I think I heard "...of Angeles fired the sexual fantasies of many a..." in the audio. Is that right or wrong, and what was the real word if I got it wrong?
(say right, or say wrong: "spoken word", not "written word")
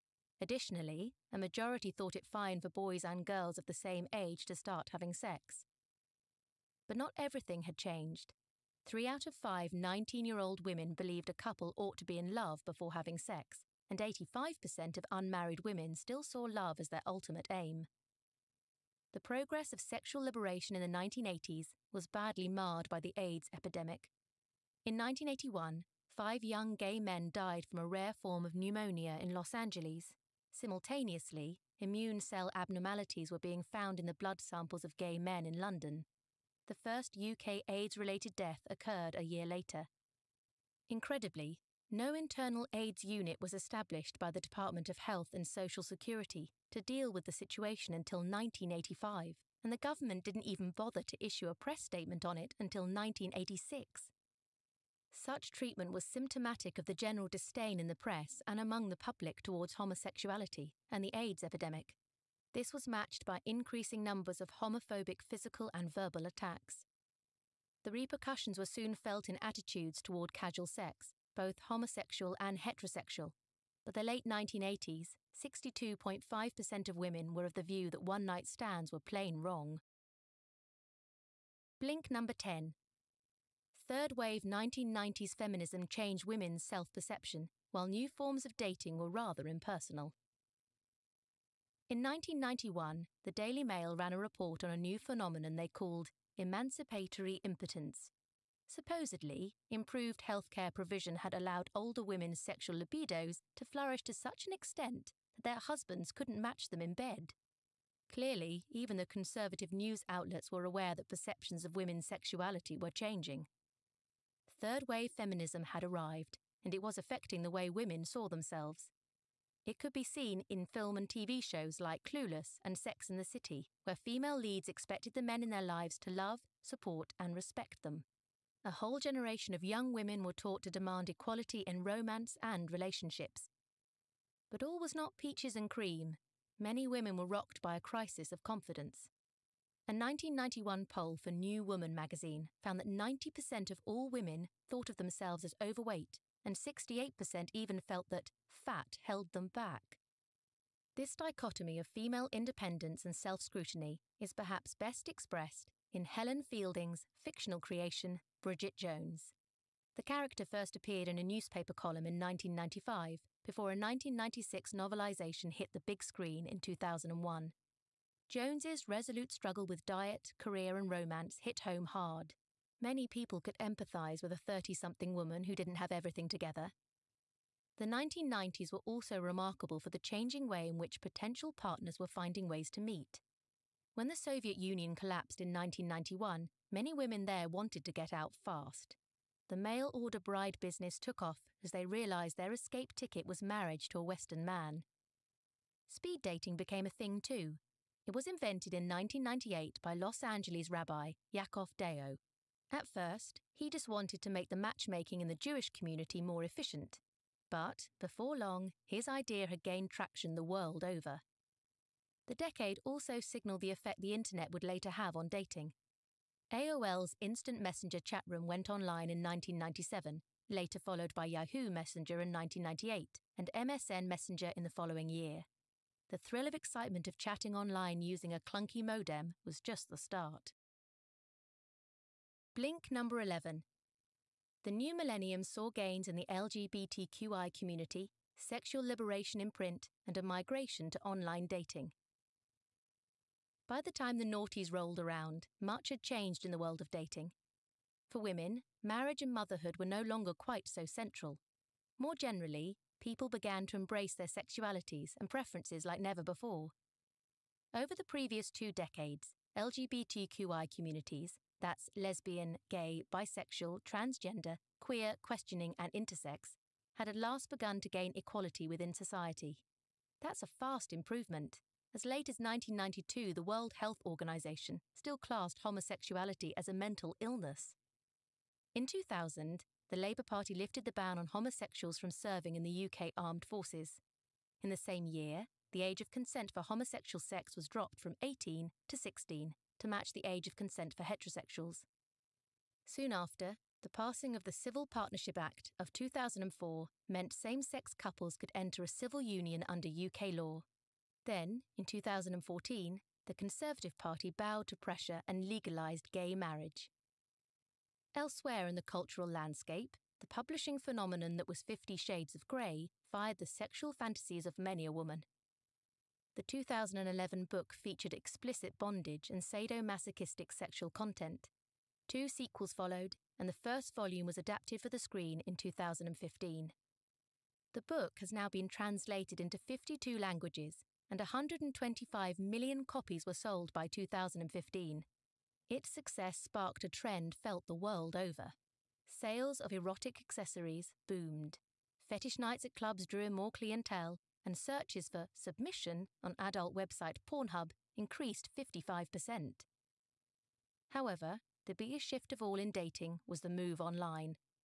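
wrong: "Grey", not "Angeles".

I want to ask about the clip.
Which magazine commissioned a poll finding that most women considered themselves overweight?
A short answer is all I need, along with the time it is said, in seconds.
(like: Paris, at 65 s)
New Woman, at 141 s.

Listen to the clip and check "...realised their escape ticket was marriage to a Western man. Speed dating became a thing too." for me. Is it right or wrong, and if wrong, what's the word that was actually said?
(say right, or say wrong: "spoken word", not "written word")
right.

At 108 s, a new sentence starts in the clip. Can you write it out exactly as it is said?
Clearly, even the conservative news outlets were aware that perceptions of women's sexuality were changing.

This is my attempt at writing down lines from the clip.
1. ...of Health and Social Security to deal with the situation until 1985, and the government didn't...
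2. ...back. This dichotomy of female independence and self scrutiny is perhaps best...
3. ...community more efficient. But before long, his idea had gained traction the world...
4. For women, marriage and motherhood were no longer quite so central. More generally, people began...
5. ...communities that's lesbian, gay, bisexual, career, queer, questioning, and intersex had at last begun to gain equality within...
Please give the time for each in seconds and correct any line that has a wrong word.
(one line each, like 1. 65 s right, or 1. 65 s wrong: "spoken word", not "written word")
1. 44 s right
2. 149 s right
3. 205 s right
4. 248 s right
5. 260 s wrong: "transgender", not "career".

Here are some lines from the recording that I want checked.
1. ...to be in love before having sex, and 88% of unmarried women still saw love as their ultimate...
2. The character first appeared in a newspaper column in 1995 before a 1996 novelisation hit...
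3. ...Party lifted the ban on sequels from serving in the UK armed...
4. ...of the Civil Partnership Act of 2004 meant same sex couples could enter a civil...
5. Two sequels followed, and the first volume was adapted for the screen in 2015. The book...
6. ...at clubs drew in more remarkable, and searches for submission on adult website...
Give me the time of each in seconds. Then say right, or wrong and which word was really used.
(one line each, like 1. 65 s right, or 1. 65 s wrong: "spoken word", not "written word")
1. 11 s wrong: "85", not "88"
2. 159 s right
3. 280 s wrong: "homosexuals", not "sequels"
4. 294 s right
5. 322 s right
6. 342 s wrong: "clientele", not "remarkable".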